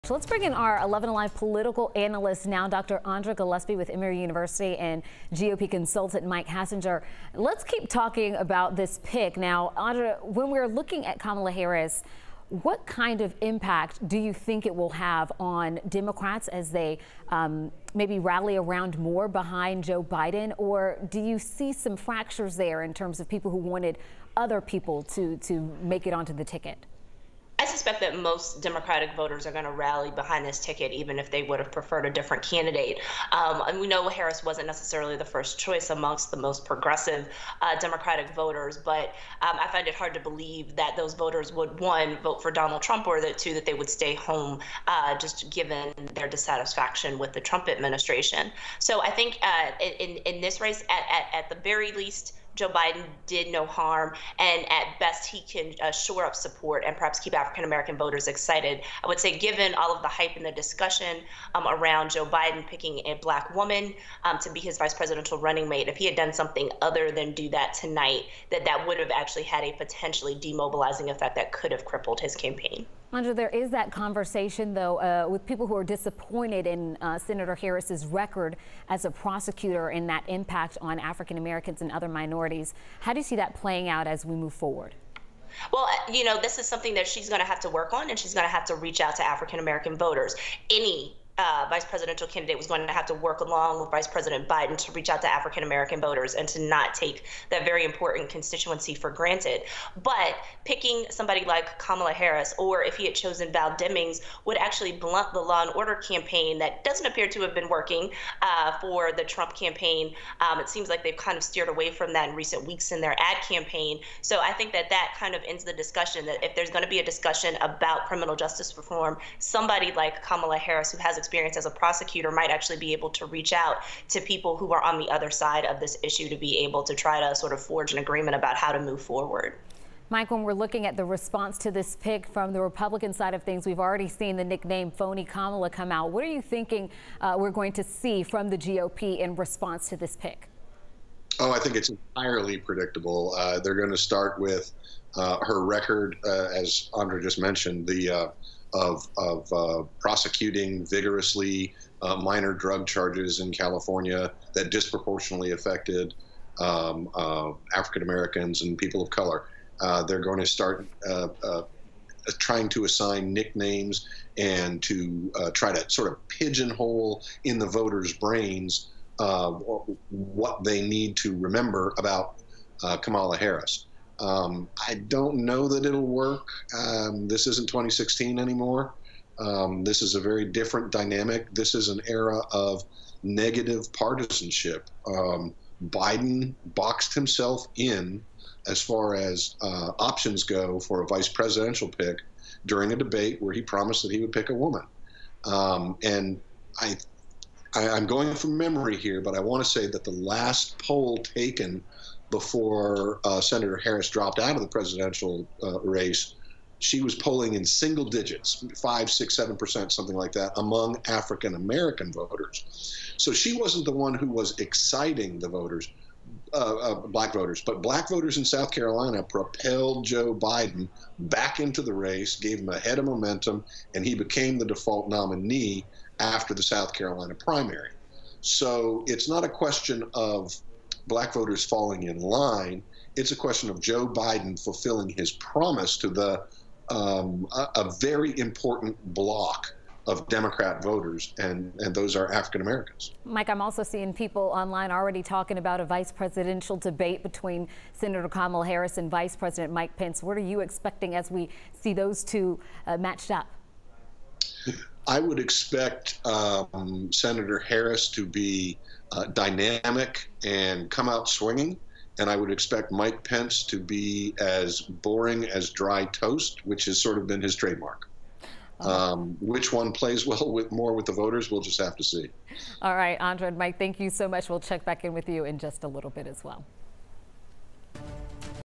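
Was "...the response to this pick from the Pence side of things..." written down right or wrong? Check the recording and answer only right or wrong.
wrong.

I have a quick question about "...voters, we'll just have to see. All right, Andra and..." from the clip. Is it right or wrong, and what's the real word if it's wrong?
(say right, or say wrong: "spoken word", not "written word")
right.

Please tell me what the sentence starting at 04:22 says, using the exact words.
And I would expect Mike Pence to be as boring as dry toast, which has sort of been his trademark.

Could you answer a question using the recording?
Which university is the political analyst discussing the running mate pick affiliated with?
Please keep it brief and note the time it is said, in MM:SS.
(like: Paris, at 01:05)
Emory University, at 00:03.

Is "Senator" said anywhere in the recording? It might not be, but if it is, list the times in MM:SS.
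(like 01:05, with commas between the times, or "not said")
01:17, 03:23, 04:07, 04:17.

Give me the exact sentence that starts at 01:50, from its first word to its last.
Um, it seems like they've kind of steered away from that in recent weeks in their ad campaign.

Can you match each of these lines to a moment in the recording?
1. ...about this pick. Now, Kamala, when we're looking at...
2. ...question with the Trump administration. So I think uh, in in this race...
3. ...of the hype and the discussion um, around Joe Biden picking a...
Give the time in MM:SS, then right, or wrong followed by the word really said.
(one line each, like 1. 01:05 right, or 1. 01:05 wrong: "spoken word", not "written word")
1. 00:08 wrong: "Andra", not "Kamala"
2. 00:46 wrong: "dissatisfaction", not "question"
3. 00:59 right.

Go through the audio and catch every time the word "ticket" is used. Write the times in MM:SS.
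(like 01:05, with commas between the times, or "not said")
00:26, 00:30.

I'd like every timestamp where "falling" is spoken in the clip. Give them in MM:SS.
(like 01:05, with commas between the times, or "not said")
03:51.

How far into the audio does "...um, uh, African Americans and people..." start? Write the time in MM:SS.
02:36.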